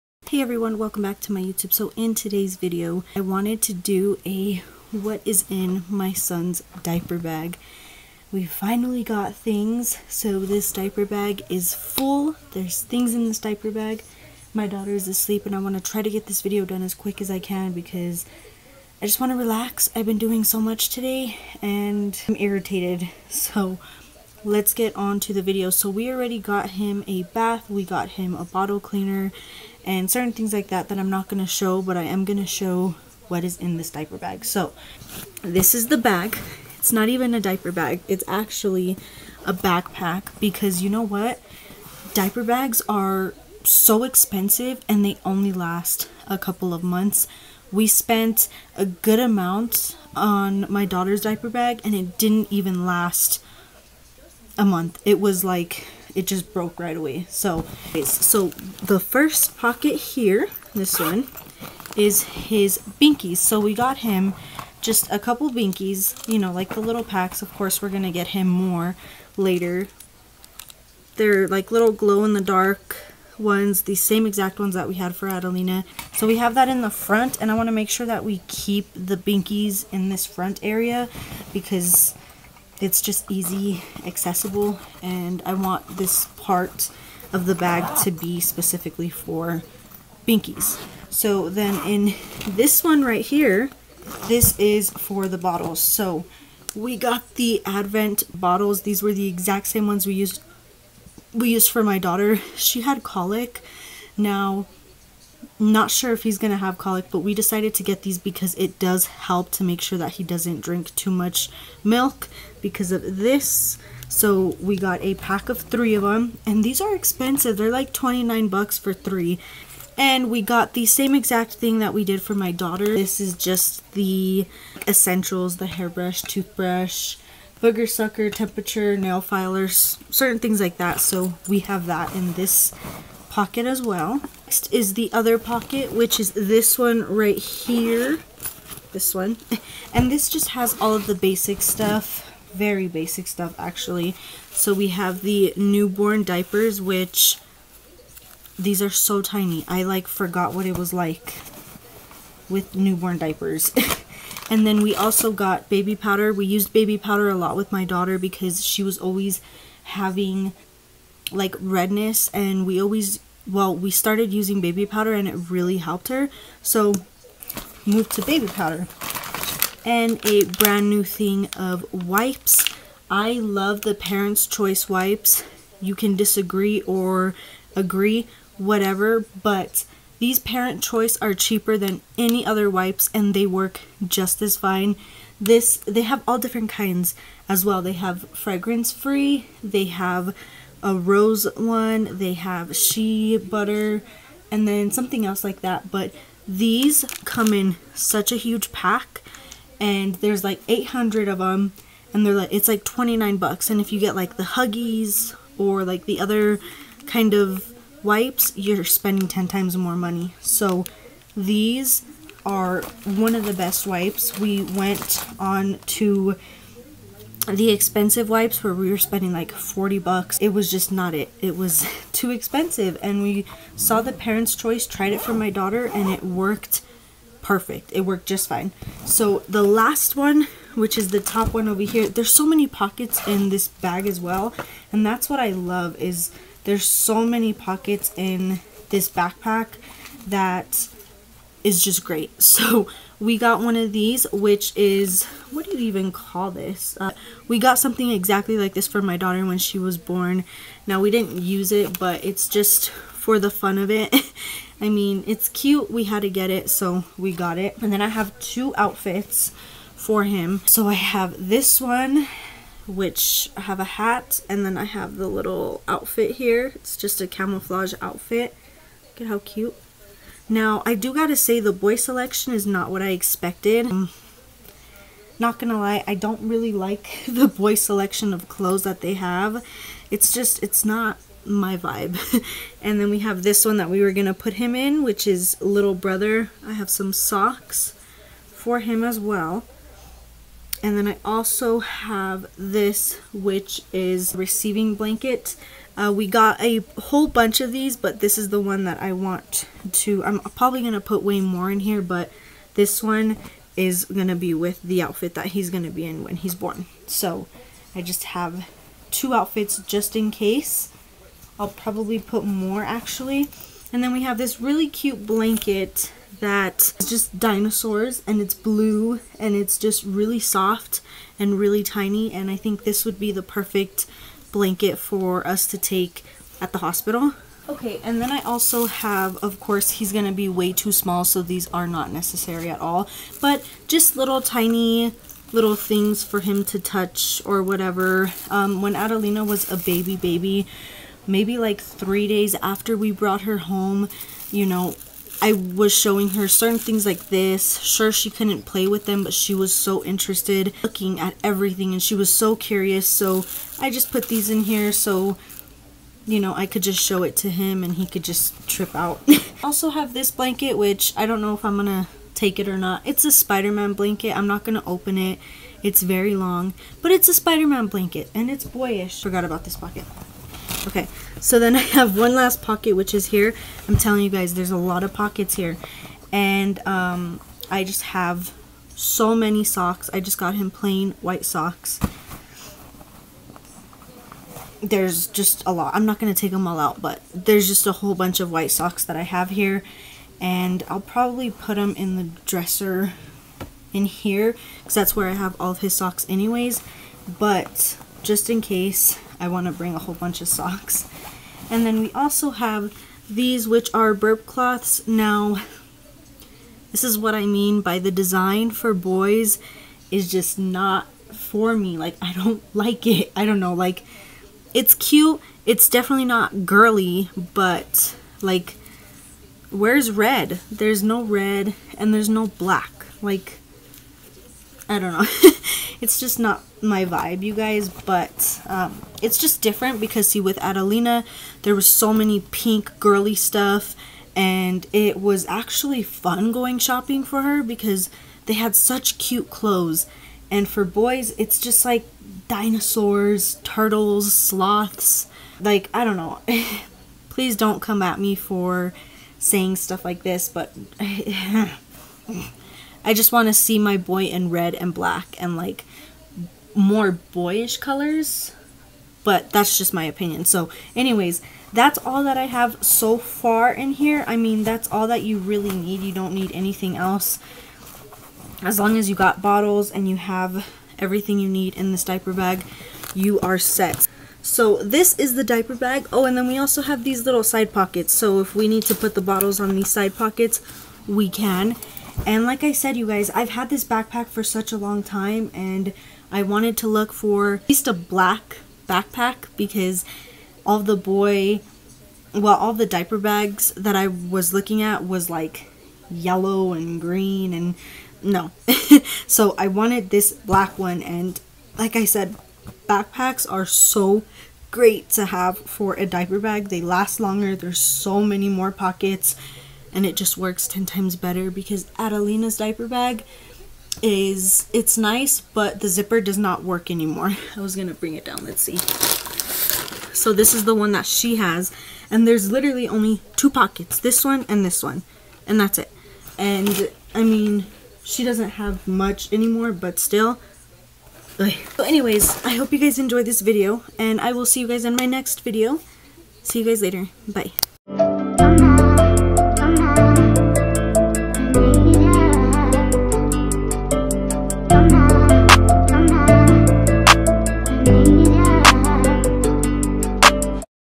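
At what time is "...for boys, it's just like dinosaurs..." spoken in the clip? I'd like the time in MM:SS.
07:20.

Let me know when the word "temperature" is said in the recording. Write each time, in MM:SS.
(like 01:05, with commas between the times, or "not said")
02:08.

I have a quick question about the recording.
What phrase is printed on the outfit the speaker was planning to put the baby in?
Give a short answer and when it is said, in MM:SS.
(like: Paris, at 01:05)
Little Brother, at 04:45.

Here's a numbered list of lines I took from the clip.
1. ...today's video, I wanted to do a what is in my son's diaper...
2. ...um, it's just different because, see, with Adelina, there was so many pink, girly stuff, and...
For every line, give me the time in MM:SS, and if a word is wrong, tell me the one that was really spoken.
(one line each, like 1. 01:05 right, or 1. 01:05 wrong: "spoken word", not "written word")
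1. 00:02 right
2. 07:08 right.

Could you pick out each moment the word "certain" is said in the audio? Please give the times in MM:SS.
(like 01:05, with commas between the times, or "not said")
00:30, 02:10, 05:46.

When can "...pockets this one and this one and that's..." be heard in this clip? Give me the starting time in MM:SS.
08:43.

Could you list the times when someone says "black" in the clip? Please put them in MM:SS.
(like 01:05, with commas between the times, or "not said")
07:02, 07:34, 08:07, 08:20.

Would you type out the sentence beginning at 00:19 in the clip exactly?
I've been doing so much today and I'm irritated.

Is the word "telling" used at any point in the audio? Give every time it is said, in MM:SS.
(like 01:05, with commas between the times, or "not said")
06:13.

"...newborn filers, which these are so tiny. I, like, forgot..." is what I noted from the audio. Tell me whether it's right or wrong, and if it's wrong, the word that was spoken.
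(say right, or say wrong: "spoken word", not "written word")
wrong: "diapers", not "filers".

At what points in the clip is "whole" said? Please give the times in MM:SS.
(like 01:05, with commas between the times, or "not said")
04:56, 06:27, 06:39.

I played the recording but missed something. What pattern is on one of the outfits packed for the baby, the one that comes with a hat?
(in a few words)
Camouflage.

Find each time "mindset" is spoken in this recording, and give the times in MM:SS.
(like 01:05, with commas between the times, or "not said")
not said.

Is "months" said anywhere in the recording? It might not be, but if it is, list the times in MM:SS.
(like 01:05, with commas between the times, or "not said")
00:46, 00:54.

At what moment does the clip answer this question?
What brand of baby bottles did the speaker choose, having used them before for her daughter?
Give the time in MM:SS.
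01:37.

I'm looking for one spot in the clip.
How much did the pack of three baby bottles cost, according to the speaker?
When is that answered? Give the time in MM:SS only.
01:57.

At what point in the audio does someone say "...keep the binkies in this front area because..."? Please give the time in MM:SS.
01:18.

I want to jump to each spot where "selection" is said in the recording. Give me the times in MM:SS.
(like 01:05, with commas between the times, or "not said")
04:31, 04:37.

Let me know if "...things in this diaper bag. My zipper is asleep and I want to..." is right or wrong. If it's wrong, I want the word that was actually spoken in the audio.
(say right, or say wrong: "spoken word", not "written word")
wrong: "daughter", not "zipper".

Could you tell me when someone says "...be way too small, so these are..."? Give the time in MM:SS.
05:30.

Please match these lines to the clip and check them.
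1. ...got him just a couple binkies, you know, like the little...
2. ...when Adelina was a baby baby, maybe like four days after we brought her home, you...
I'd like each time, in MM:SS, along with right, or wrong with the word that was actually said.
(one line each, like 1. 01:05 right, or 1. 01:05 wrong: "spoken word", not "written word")
1. 01:03 right
2. 05:38 wrong: "three", not "four".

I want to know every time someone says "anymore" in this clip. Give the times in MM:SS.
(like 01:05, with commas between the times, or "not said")
08:36, 08:49.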